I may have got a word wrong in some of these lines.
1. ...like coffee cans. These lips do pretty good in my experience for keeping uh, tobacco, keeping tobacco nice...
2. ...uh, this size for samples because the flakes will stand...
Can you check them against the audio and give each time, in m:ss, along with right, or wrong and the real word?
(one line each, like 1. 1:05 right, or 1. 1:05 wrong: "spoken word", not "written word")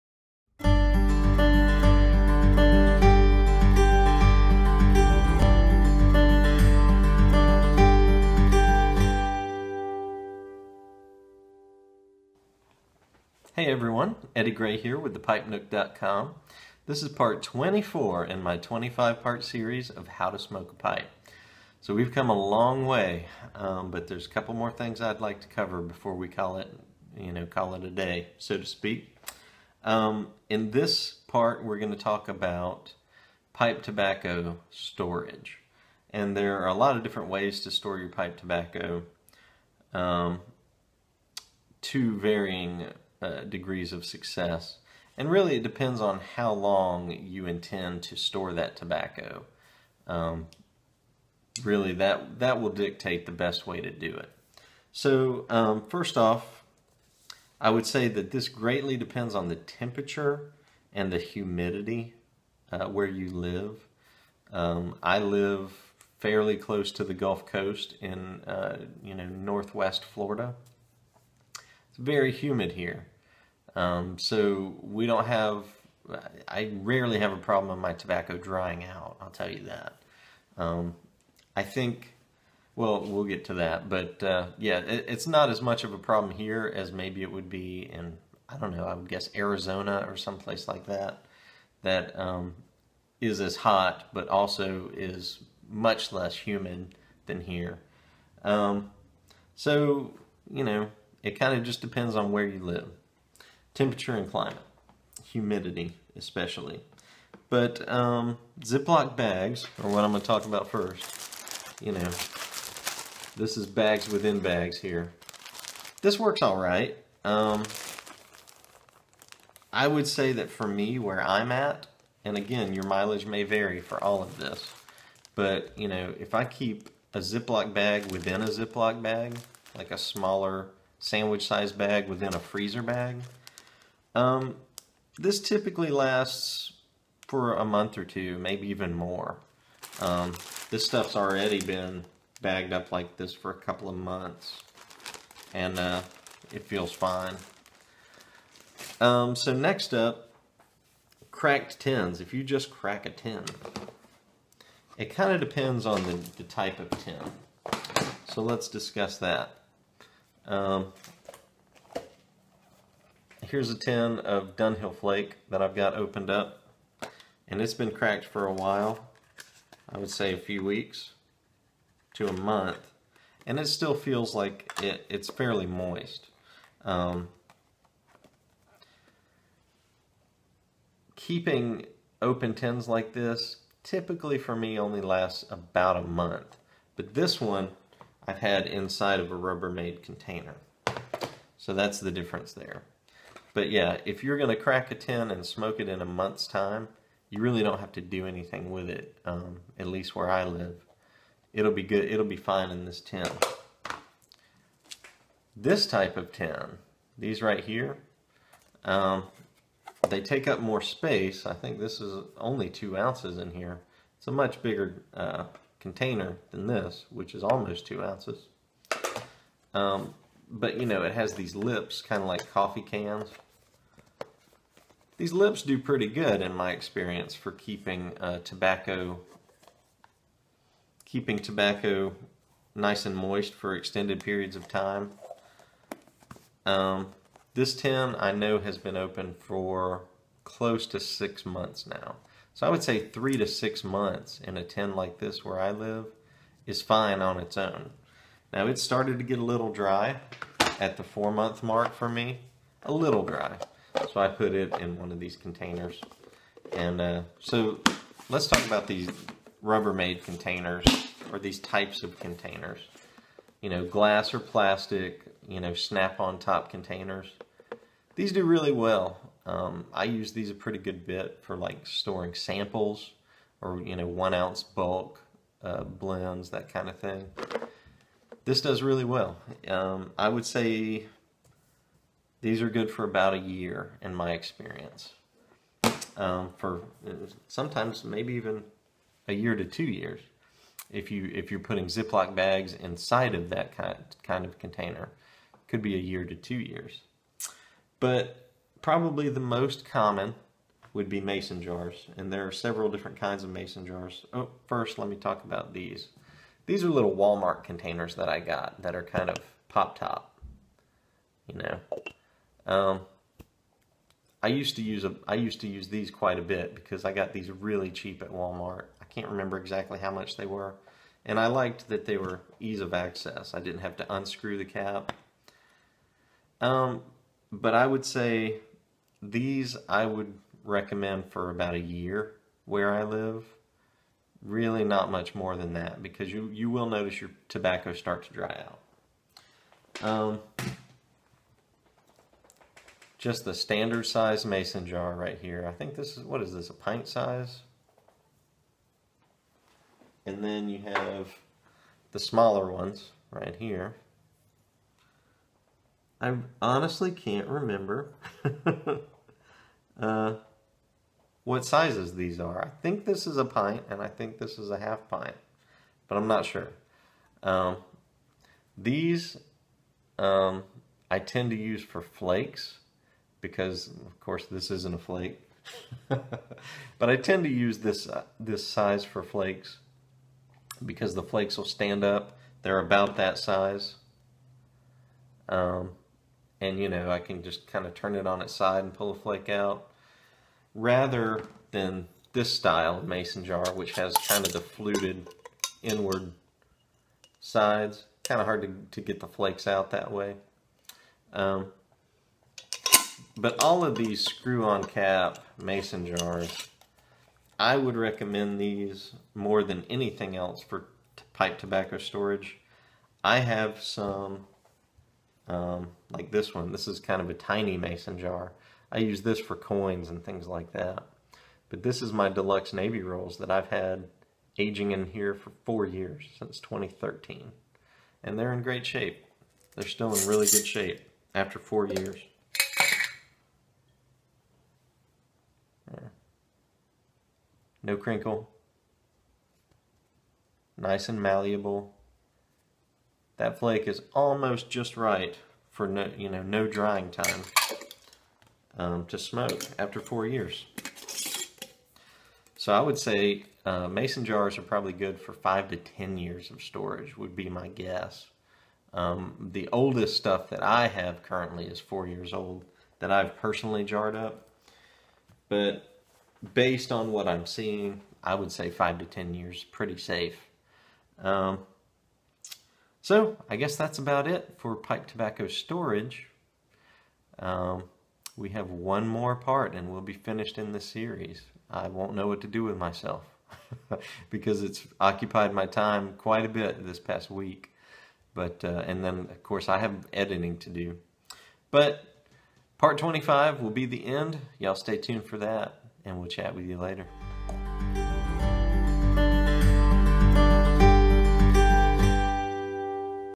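1. 3:42 right
2. 6:18 wrong: "flakes", not "samples".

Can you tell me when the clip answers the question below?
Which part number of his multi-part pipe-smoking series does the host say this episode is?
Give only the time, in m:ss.
0:17.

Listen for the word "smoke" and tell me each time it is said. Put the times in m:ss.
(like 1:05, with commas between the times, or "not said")
0:20, 3:15, 7:29.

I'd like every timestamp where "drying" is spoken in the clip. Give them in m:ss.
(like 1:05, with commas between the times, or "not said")
1:18, 7:26.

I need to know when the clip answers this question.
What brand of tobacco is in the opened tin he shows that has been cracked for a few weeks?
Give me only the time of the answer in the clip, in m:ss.
2:44.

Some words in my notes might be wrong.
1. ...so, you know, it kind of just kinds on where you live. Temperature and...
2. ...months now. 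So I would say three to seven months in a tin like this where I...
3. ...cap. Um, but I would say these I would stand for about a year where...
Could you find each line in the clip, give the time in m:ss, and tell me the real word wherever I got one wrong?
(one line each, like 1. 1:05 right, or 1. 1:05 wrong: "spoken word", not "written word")
1. 1:39 wrong: "depends", not "kinds"
2. 4:01 wrong: "six", not "seven"
3. 5:24 wrong: "recommend", not "stand".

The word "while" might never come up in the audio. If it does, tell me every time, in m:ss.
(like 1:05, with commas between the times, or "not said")
2:48.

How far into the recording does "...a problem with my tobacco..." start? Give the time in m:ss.
1:17.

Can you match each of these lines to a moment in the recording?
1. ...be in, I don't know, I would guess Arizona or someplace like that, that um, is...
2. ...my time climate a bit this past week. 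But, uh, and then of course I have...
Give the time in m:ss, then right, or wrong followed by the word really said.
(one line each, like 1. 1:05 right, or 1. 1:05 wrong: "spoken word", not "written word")
1. 1:27 right
2. 8:05 wrong: "quite", not "climate".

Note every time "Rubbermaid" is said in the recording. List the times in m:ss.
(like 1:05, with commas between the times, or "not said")
3:09, 4:19.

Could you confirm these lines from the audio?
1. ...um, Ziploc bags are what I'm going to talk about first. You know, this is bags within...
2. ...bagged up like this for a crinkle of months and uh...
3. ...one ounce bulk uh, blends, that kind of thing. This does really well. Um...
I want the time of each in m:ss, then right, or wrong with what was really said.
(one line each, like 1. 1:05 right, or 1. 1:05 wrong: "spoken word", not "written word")
1. 1:47 right
2. 2:22 wrong: "couple", not "crinkle"
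3. 4:34 right.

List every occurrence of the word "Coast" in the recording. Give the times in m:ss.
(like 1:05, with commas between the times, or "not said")
1:07.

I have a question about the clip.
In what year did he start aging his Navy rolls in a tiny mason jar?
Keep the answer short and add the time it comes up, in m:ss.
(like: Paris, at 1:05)
2013, at 7:06.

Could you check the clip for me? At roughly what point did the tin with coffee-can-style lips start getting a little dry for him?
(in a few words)
4 months.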